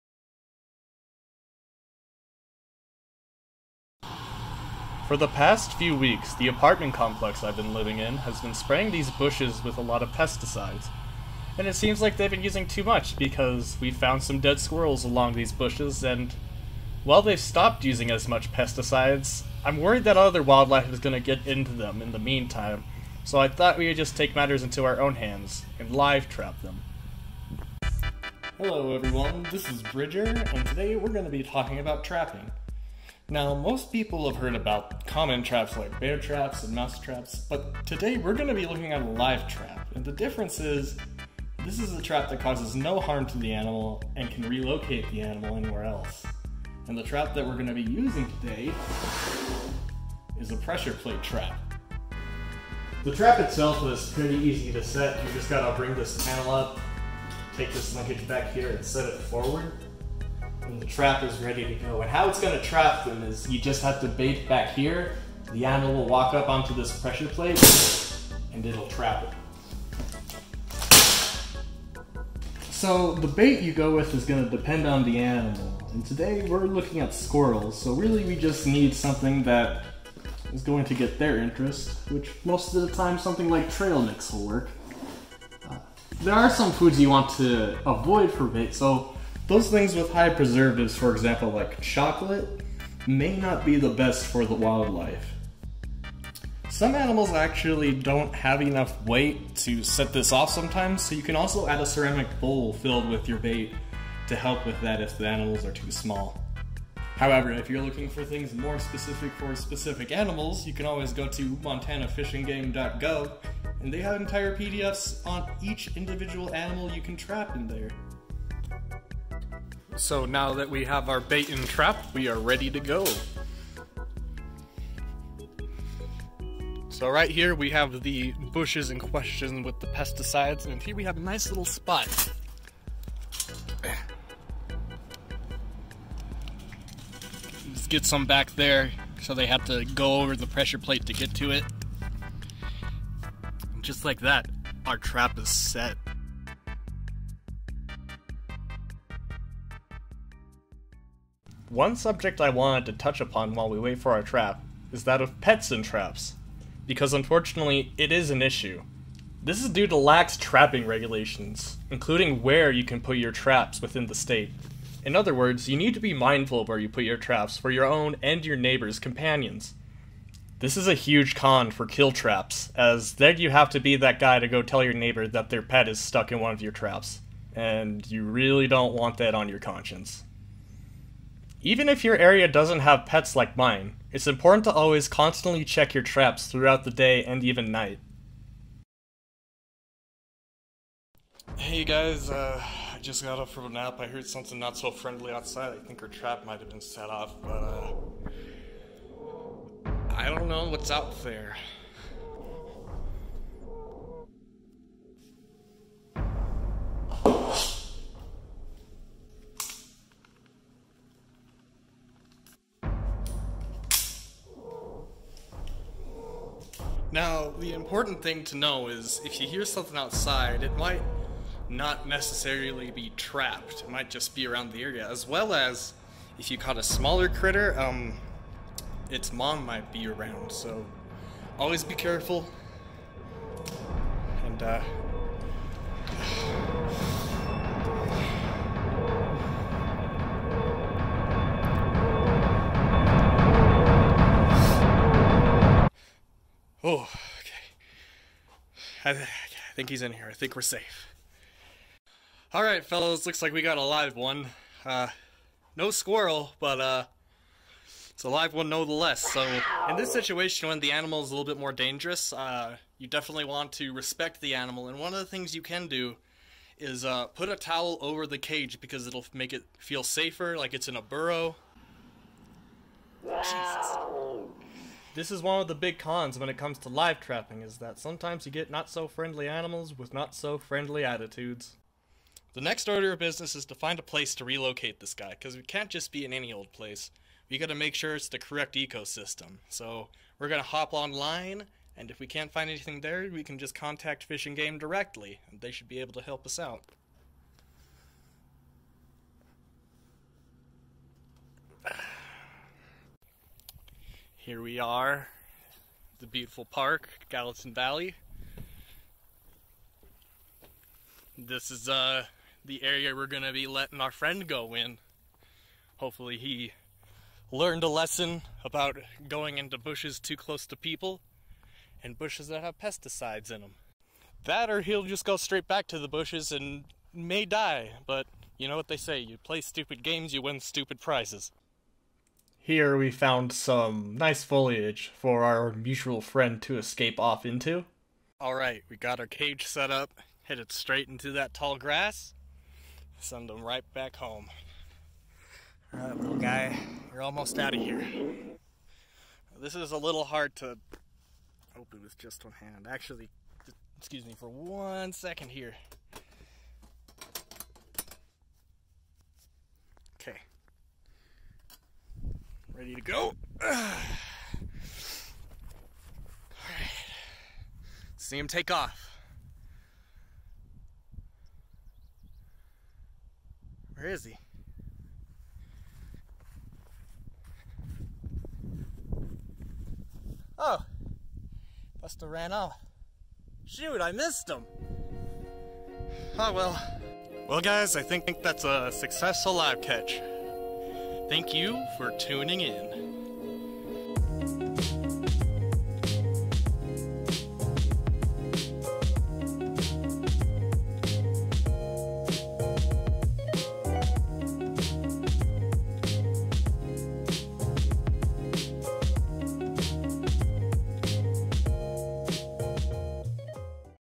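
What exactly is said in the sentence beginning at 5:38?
Alright, we got our cage set up, headed straight into that tall grass, send him right back home.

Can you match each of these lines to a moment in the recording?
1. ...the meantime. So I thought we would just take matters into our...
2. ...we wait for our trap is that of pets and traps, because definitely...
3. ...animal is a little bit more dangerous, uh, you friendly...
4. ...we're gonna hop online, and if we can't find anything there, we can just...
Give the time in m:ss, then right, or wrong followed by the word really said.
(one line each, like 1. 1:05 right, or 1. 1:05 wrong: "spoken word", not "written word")
1. 0:22 right
2. 2:33 wrong: "unfortunately", not "definitely"
3. 4:20 wrong: "definitely", not "friendly"
4. 4:50 right.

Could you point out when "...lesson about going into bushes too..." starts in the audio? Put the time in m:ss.
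5:17.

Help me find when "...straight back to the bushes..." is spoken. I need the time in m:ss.
5:25.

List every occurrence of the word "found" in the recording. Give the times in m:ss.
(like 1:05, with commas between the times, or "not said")
0:13, 5:33.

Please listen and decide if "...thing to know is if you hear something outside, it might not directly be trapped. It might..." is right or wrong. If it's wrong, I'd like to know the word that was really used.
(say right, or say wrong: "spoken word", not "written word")
wrong: "necessarily", not "directly".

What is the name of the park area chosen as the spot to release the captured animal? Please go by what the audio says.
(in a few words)
Gallatin Valley.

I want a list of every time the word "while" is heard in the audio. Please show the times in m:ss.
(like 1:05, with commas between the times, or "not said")
0:17, 2:33.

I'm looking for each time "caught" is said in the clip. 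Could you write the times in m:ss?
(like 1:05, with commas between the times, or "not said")
3:46.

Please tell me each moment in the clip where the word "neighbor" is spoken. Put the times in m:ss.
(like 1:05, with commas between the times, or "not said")
2:48, 2:54.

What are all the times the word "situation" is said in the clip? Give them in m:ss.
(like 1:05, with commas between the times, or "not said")
4:20.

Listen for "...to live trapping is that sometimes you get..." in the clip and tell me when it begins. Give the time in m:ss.
4:36.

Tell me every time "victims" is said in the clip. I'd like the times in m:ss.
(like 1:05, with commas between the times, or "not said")
not said.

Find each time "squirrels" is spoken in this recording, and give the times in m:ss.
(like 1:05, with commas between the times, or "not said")
0:14, 1:17, 4:15.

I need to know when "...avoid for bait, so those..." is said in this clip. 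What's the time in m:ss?
1:27.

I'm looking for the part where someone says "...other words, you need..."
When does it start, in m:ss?
2:45.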